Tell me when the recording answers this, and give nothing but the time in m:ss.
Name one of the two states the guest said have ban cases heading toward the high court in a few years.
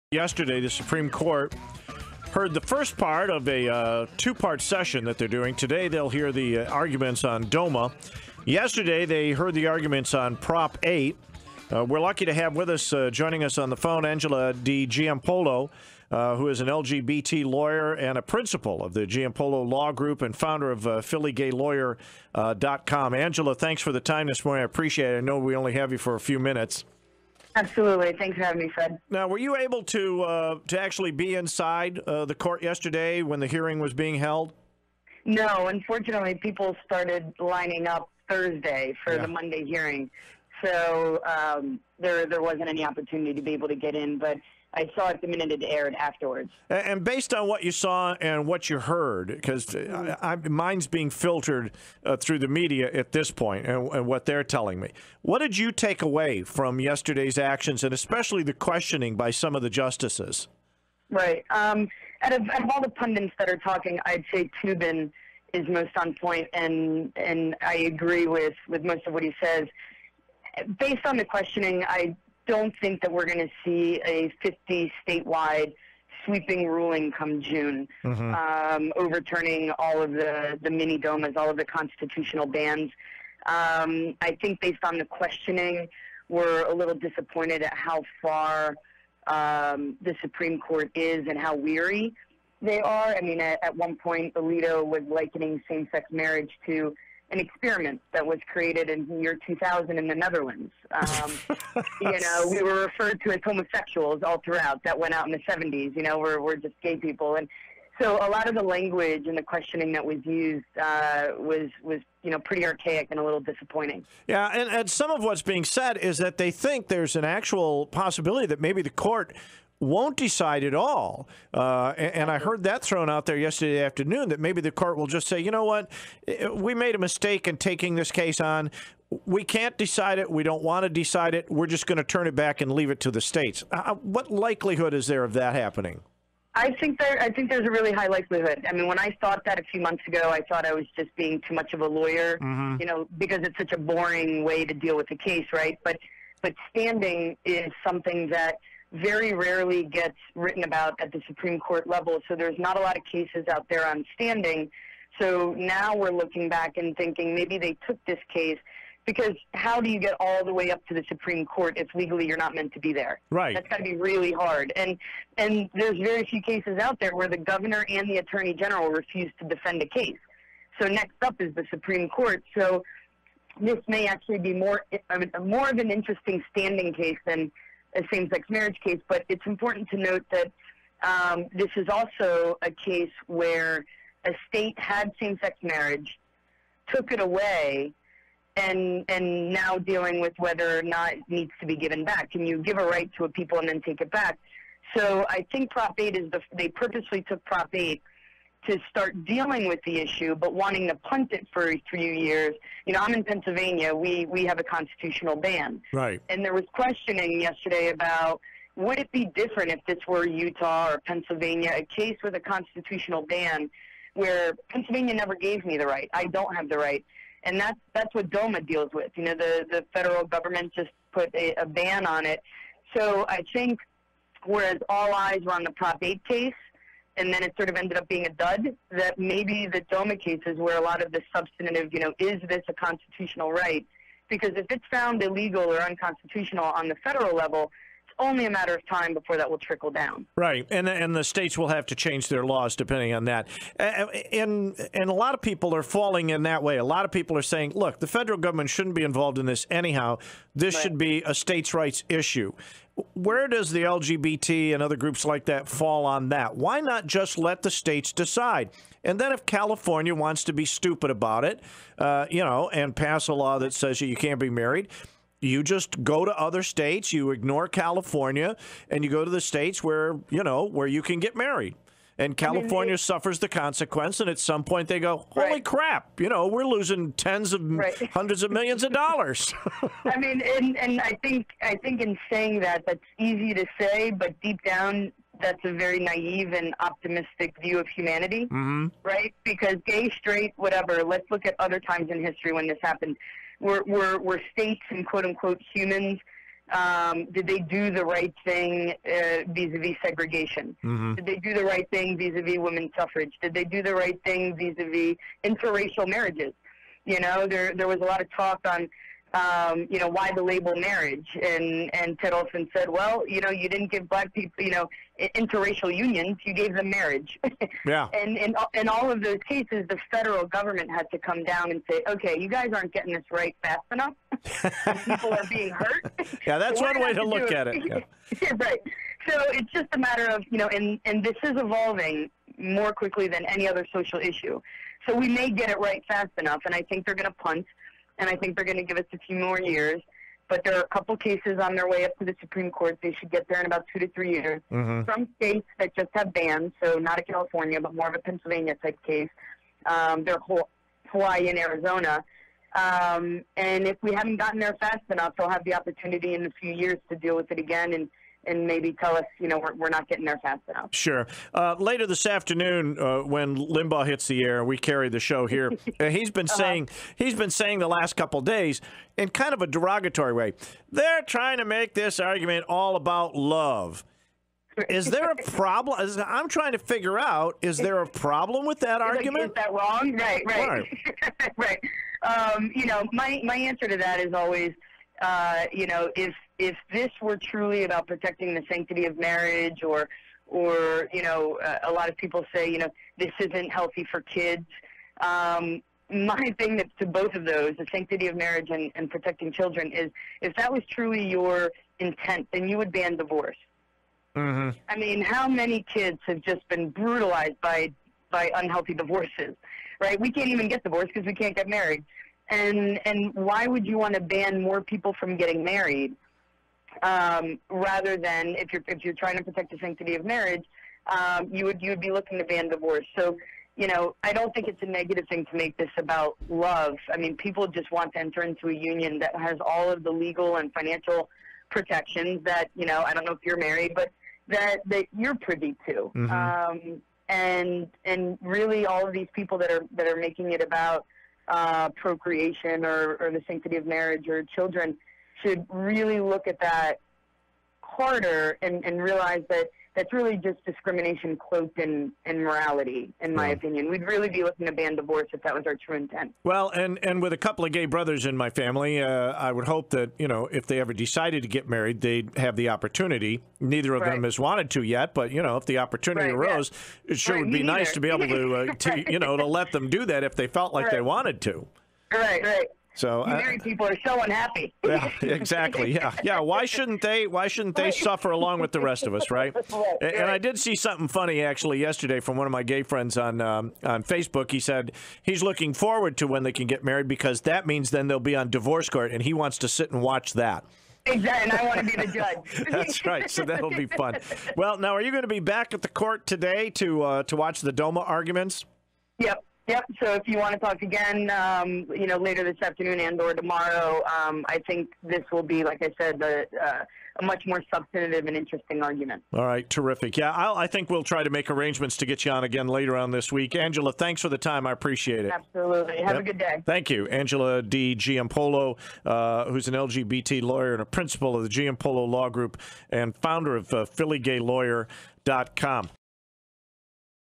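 5:51.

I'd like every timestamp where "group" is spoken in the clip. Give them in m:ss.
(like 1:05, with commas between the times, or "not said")
0:19, 4:14, 8:42.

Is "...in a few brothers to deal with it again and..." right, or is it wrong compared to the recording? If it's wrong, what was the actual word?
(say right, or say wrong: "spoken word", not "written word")
wrong: "years", not "brothers".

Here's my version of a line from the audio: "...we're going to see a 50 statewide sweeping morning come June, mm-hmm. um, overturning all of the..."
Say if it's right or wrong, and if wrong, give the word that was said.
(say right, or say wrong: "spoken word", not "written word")
wrong: "ruling", not "morning".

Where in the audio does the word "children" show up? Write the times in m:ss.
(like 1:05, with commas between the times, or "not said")
6:39, 7:24.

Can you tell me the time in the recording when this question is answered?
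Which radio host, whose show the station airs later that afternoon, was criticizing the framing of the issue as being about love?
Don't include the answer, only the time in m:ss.
6:03.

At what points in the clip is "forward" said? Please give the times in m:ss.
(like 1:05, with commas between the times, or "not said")
8:05.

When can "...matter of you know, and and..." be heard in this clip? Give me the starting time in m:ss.
5:29.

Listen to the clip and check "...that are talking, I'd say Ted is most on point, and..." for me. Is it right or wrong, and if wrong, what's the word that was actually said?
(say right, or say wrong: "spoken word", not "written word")
wrong: "Toobin", not "Ted".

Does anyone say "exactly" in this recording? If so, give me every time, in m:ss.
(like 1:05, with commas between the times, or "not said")
7:55, 8:11.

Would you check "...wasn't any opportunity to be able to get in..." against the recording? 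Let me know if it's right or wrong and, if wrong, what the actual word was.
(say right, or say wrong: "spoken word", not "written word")
right.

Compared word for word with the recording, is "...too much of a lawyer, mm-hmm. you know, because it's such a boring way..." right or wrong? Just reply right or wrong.
right.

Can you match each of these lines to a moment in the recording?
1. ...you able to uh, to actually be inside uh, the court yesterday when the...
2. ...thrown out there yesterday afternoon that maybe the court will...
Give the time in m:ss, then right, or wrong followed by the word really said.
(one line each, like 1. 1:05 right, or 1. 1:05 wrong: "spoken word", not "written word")
1. 0:29 right
2. 2:02 right.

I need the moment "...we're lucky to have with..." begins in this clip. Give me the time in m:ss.
0:11.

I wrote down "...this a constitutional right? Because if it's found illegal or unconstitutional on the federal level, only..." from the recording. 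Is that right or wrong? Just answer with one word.
right.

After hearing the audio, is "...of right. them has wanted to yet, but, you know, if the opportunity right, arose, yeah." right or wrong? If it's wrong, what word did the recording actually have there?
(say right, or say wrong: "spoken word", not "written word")
right.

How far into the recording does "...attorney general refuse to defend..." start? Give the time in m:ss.
2:48.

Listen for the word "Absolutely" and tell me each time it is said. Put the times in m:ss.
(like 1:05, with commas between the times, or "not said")
0:27, 8:35.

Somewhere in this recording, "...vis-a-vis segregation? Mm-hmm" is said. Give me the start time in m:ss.
4:59.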